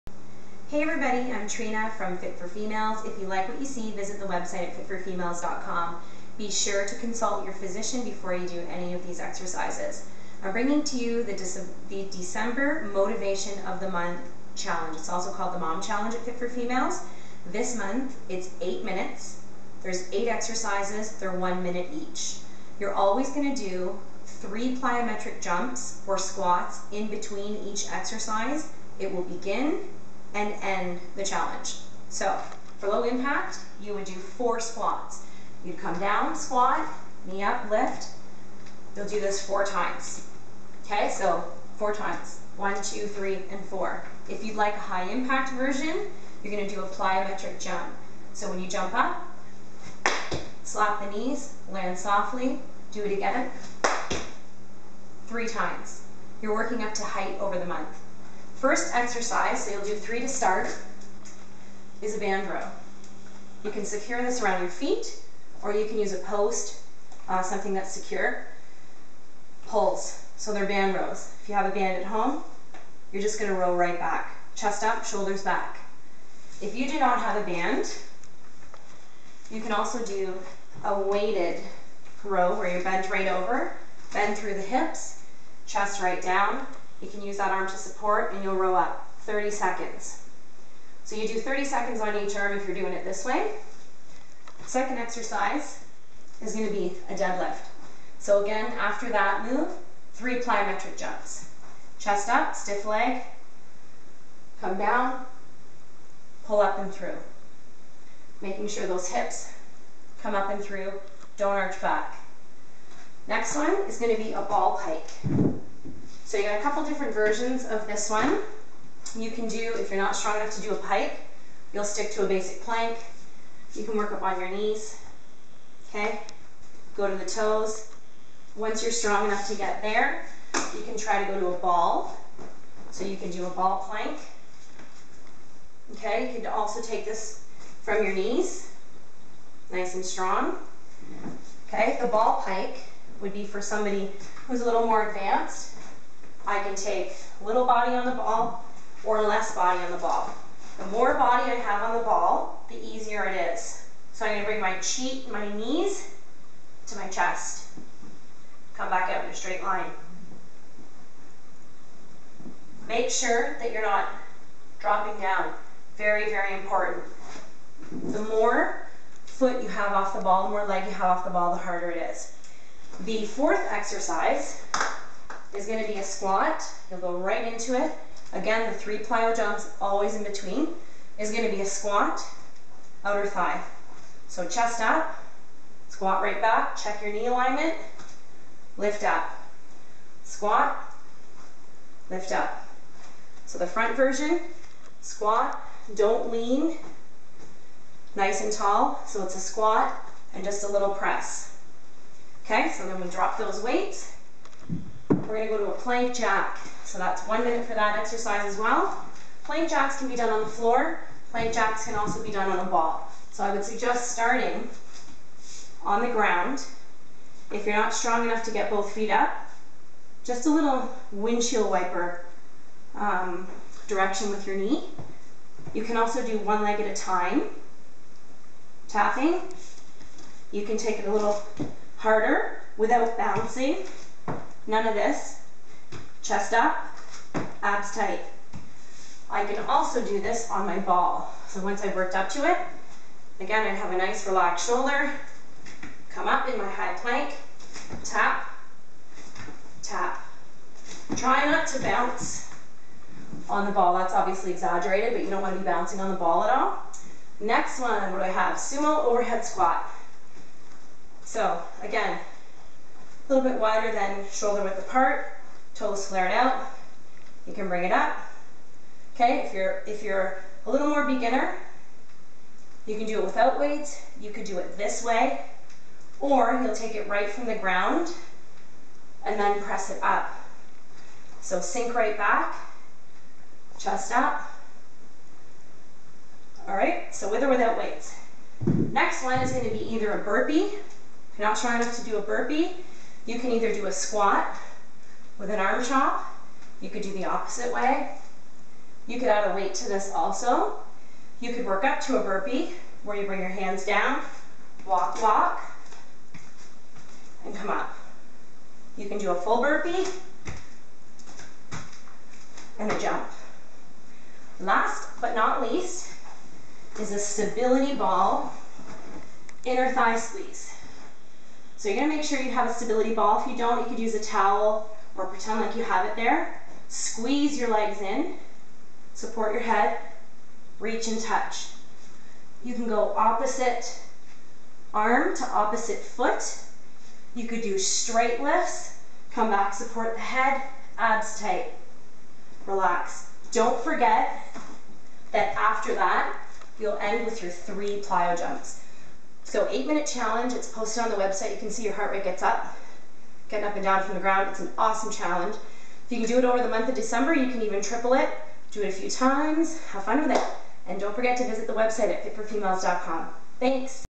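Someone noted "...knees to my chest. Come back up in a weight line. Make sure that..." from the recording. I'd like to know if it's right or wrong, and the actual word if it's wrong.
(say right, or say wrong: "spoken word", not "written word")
wrong: "straight", not "weight".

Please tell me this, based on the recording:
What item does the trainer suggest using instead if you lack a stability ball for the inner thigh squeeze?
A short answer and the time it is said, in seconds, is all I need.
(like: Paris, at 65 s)
towel, at 324 s.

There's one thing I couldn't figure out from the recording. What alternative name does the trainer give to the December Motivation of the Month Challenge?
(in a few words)
Mom Challenge.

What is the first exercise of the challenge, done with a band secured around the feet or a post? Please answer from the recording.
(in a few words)
band row.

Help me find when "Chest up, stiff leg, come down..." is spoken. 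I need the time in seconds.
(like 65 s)
101 s.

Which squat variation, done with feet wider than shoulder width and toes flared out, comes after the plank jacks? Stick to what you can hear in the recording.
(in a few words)
Sumo overhead squat.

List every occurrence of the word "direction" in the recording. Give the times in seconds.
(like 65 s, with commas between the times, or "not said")
223 s.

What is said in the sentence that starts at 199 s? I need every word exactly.
So it's a squat and just a little press.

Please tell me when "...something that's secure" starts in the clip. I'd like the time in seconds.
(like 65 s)
67 s.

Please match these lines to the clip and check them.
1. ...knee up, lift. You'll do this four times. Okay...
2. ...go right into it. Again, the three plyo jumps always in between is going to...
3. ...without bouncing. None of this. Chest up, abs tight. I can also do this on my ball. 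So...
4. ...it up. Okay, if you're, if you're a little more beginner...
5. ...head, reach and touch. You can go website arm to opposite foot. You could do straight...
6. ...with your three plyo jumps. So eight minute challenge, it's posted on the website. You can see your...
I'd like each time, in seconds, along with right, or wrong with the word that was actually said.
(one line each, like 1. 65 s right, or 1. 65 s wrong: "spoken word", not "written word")
1. 37 s right
2. 177 s right
3. 232 s right
4. 267 s right
5. 329 s wrong: "opposite", not "website"
6. 347 s right.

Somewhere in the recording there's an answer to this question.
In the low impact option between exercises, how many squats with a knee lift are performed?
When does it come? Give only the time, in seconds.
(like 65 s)
34 s.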